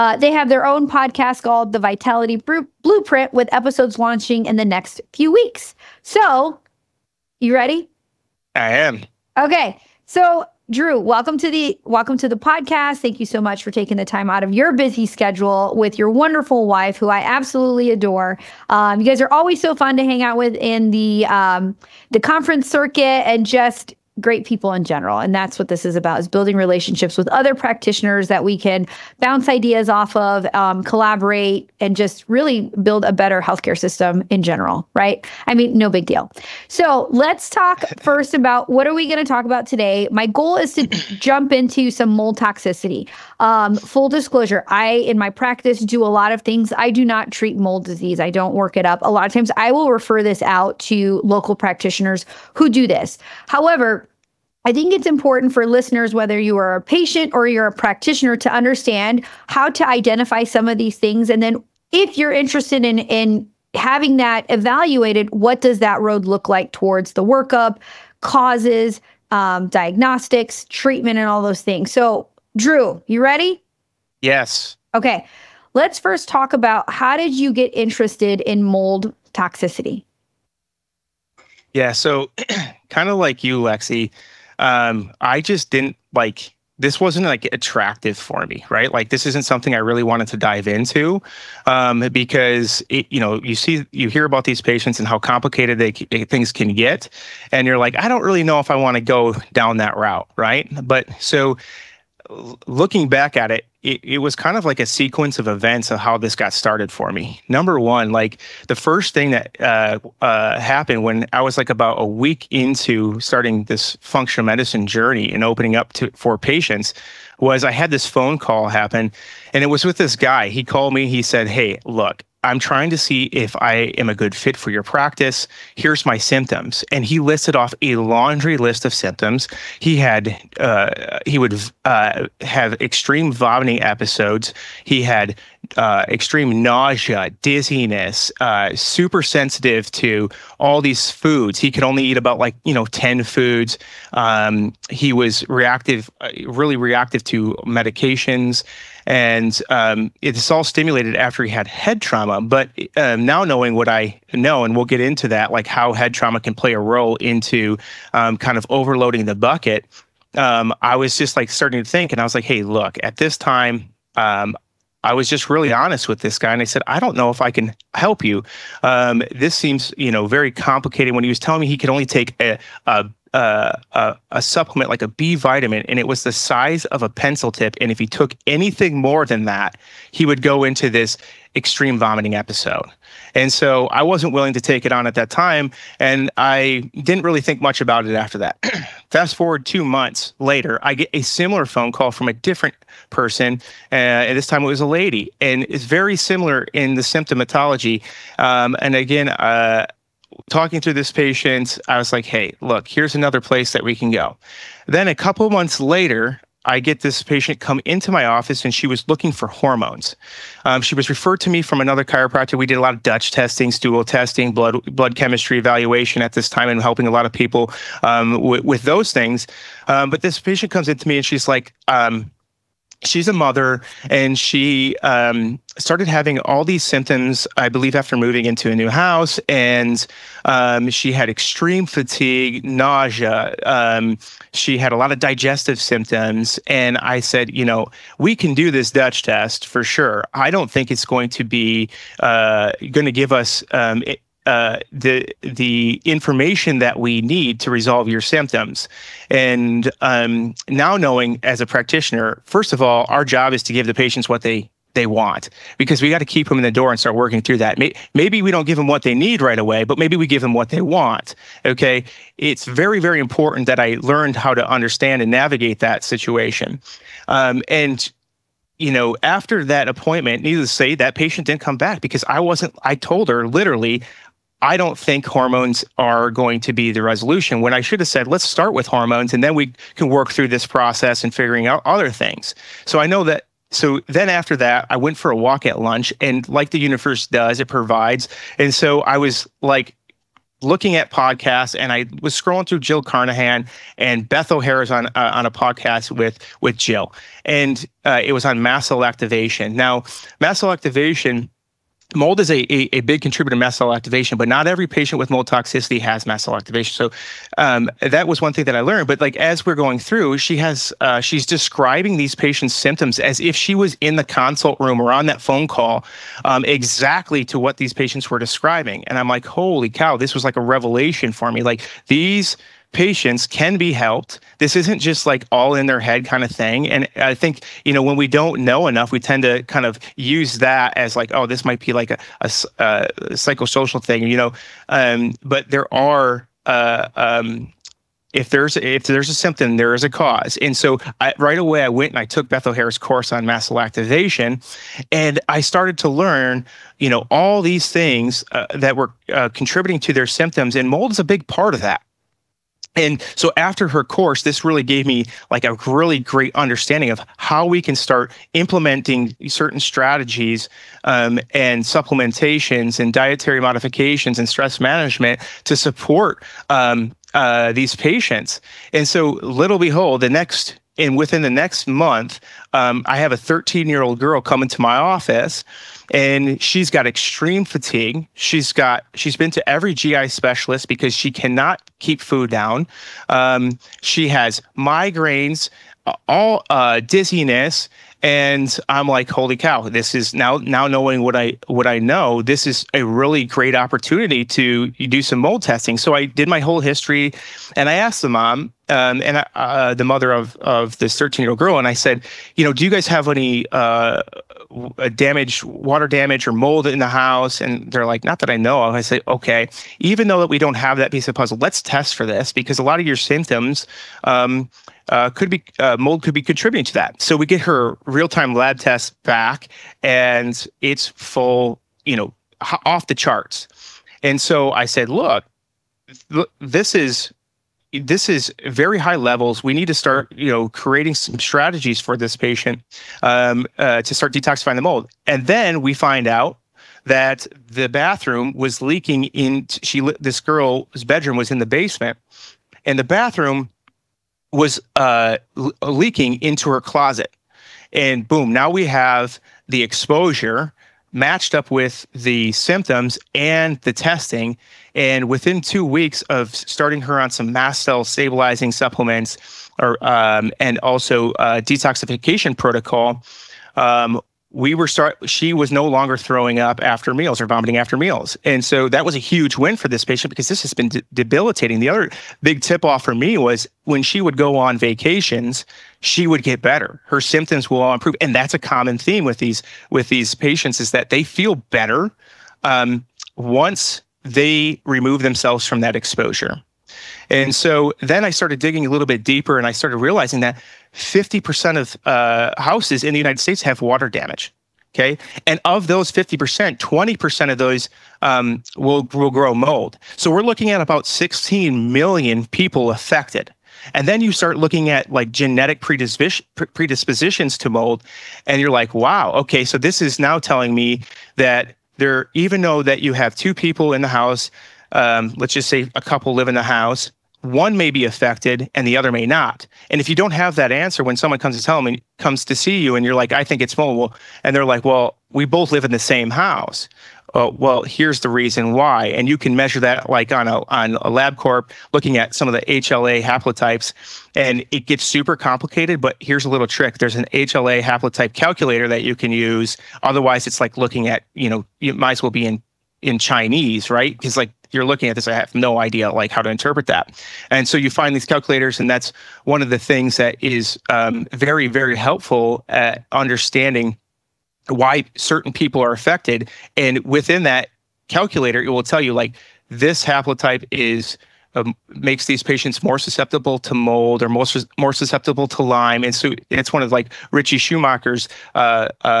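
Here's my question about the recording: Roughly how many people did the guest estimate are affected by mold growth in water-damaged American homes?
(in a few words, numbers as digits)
16 million.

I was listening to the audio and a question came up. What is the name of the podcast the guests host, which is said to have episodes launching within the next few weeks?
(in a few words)
The Vitality Blueprint.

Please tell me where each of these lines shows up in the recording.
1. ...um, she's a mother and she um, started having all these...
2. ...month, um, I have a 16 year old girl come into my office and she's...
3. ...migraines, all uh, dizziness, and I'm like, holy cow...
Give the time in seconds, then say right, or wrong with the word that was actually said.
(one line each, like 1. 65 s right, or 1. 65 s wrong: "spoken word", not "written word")
1. 221 s right
2. 371 s wrong: "13", not "16"
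3. 384 s right.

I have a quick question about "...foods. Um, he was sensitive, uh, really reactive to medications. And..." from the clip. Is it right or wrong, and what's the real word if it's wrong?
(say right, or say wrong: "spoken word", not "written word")
wrong: "reactive", not "sensitive".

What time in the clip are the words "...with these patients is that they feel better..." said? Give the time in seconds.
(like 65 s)
479 s.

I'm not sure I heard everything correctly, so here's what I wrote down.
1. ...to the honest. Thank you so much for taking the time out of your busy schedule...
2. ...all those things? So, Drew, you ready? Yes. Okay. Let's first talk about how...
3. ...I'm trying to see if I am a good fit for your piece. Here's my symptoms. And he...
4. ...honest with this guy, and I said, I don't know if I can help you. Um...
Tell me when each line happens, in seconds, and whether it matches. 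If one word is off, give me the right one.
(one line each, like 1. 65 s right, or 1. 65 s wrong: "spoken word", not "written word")
1. 12 s wrong: "podcast", not "honest"
2. 71 s right
3. 122 s wrong: "practice", not "piece"
4. 165 s right.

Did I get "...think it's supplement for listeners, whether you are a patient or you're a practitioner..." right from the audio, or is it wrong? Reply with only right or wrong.
wrong.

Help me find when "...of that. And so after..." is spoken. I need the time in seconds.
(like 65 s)
351 s.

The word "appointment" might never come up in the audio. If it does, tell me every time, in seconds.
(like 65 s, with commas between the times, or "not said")
269 s.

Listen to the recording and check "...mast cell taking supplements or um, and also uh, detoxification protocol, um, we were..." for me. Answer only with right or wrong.
wrong.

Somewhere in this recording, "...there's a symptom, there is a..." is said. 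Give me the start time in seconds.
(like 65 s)
339 s.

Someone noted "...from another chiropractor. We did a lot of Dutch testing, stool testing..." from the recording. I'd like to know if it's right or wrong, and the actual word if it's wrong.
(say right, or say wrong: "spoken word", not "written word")
right.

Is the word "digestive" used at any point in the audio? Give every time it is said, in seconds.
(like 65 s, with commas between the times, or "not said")
235 s.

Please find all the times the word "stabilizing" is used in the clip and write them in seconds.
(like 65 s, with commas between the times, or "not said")
458 s.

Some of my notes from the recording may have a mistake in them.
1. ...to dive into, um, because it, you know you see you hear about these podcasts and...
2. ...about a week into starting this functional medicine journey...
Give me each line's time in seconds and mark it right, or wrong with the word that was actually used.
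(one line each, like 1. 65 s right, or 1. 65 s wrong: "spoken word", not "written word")
1. 90 s wrong: "patients", not "podcasts"
2. 111 s right.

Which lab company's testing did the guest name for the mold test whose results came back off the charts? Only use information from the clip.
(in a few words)
Real Time.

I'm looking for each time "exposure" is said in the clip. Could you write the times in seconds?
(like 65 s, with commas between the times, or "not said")
449 s, 485 s.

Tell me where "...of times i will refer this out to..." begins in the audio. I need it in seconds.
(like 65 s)
49 s.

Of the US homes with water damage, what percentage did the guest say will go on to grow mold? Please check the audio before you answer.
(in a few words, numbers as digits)
20%.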